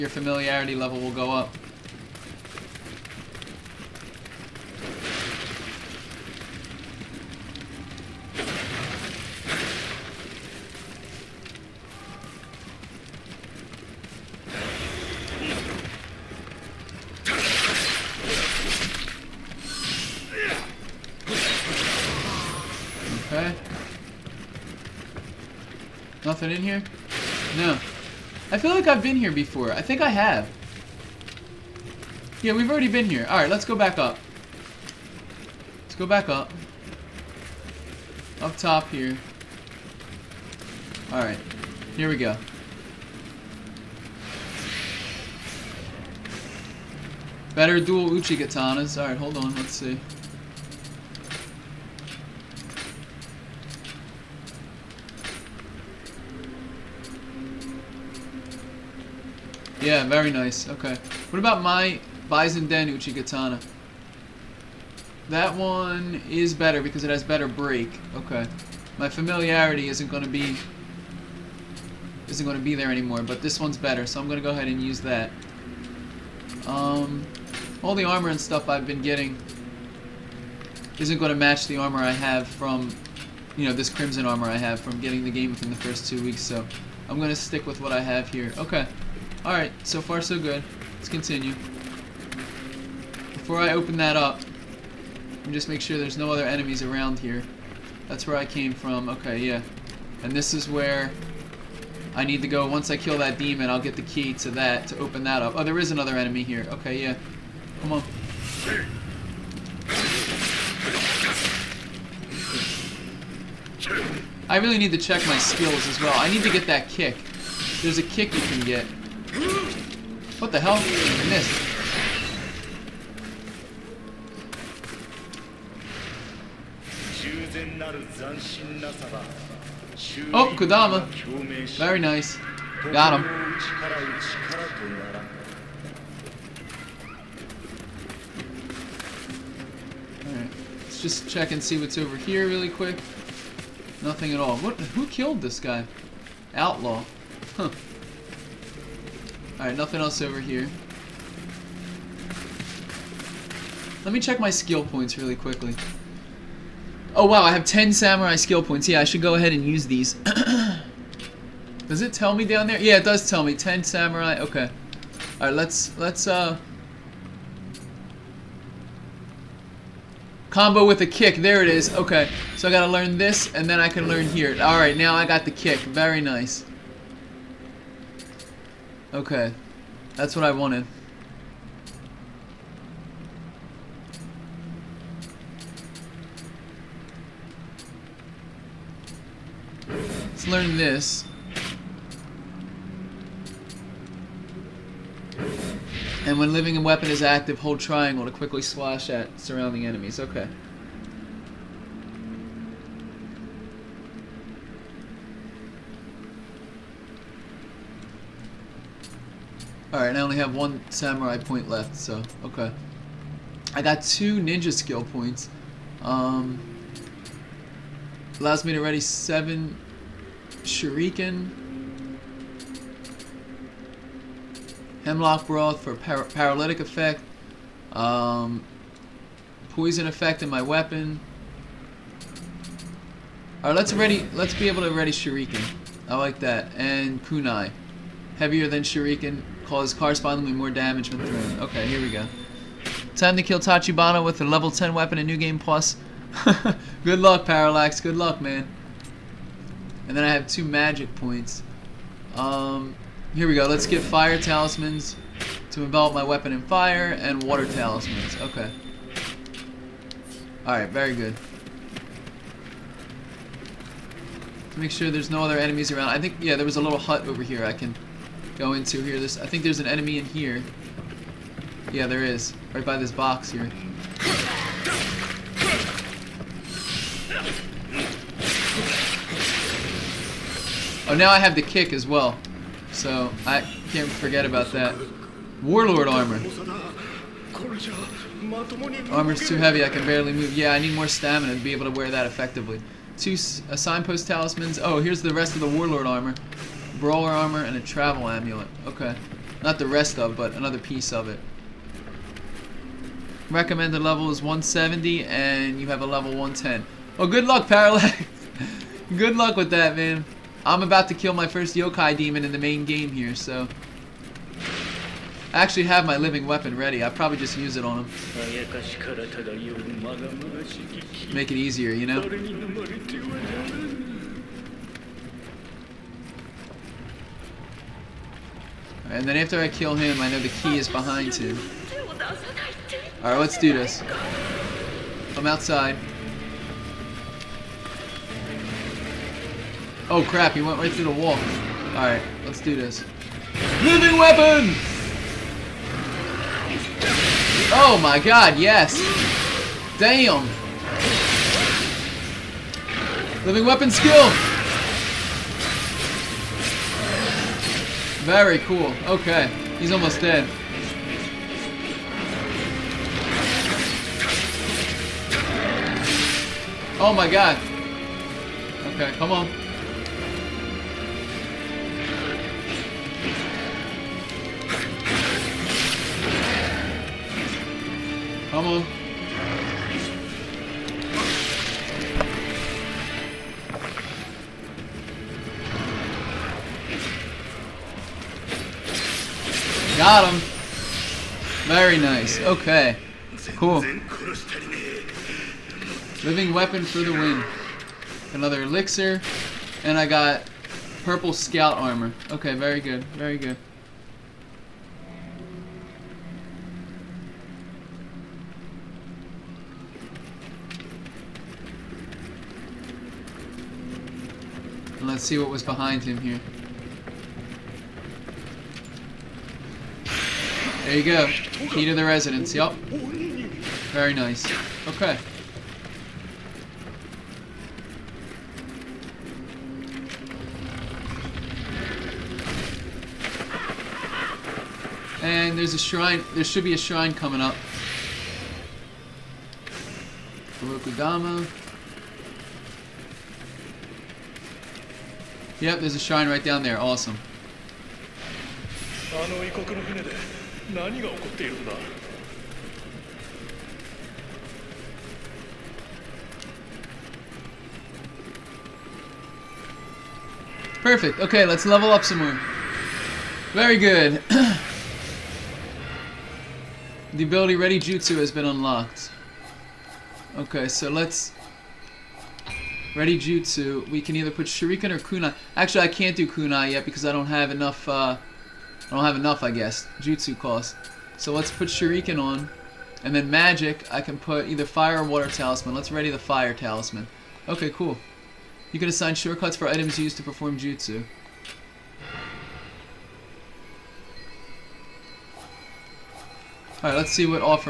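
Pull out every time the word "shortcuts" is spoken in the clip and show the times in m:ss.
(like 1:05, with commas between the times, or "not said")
8:09.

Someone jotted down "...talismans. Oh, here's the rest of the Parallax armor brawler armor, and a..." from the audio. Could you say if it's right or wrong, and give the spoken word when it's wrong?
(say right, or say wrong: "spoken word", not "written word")
wrong: "Warlord", not "Parallax".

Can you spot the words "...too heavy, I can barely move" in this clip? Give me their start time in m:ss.
4:49.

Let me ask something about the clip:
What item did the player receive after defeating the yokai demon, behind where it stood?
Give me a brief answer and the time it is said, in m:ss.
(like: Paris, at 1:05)
Key to the residence, at 7:01.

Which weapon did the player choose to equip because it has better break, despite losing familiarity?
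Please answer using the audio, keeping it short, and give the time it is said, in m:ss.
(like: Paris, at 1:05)
Bizen-den Uchi Katana, at 1:02.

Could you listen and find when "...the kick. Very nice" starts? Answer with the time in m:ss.
2:55.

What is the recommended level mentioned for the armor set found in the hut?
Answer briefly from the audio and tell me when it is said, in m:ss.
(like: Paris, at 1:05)
170, at 5:04.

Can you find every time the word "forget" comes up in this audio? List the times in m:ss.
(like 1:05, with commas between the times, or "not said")
4:44.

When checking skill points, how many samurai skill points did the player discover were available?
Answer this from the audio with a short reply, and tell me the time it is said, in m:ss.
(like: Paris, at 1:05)
10, at 2:37.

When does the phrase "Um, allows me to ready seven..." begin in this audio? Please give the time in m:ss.
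3:36.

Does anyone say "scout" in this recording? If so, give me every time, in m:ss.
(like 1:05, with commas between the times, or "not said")
6:41.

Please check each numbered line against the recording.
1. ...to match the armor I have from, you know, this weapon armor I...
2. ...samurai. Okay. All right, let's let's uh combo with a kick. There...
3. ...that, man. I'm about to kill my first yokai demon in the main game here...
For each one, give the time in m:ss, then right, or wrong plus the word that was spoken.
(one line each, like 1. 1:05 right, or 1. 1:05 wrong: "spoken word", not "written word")
1. 1:21 wrong: "crimson", not "weapon"
2. 2:43 right
3. 5:09 right.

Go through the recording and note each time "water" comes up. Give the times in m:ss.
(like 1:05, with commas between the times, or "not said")
4:17, 8:05.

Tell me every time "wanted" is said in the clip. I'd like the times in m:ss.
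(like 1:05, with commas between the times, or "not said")
3:00.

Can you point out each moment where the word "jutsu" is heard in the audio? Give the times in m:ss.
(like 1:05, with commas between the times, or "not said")
7:47, 7:53, 7:59, 8:10.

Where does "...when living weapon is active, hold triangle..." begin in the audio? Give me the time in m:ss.
3:16.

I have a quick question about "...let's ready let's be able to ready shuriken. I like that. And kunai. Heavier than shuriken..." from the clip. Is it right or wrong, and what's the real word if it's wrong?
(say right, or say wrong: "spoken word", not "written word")
right.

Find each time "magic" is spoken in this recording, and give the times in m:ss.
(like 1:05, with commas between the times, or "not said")
4:10, 8:03.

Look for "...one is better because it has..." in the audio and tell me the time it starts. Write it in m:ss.
1:05.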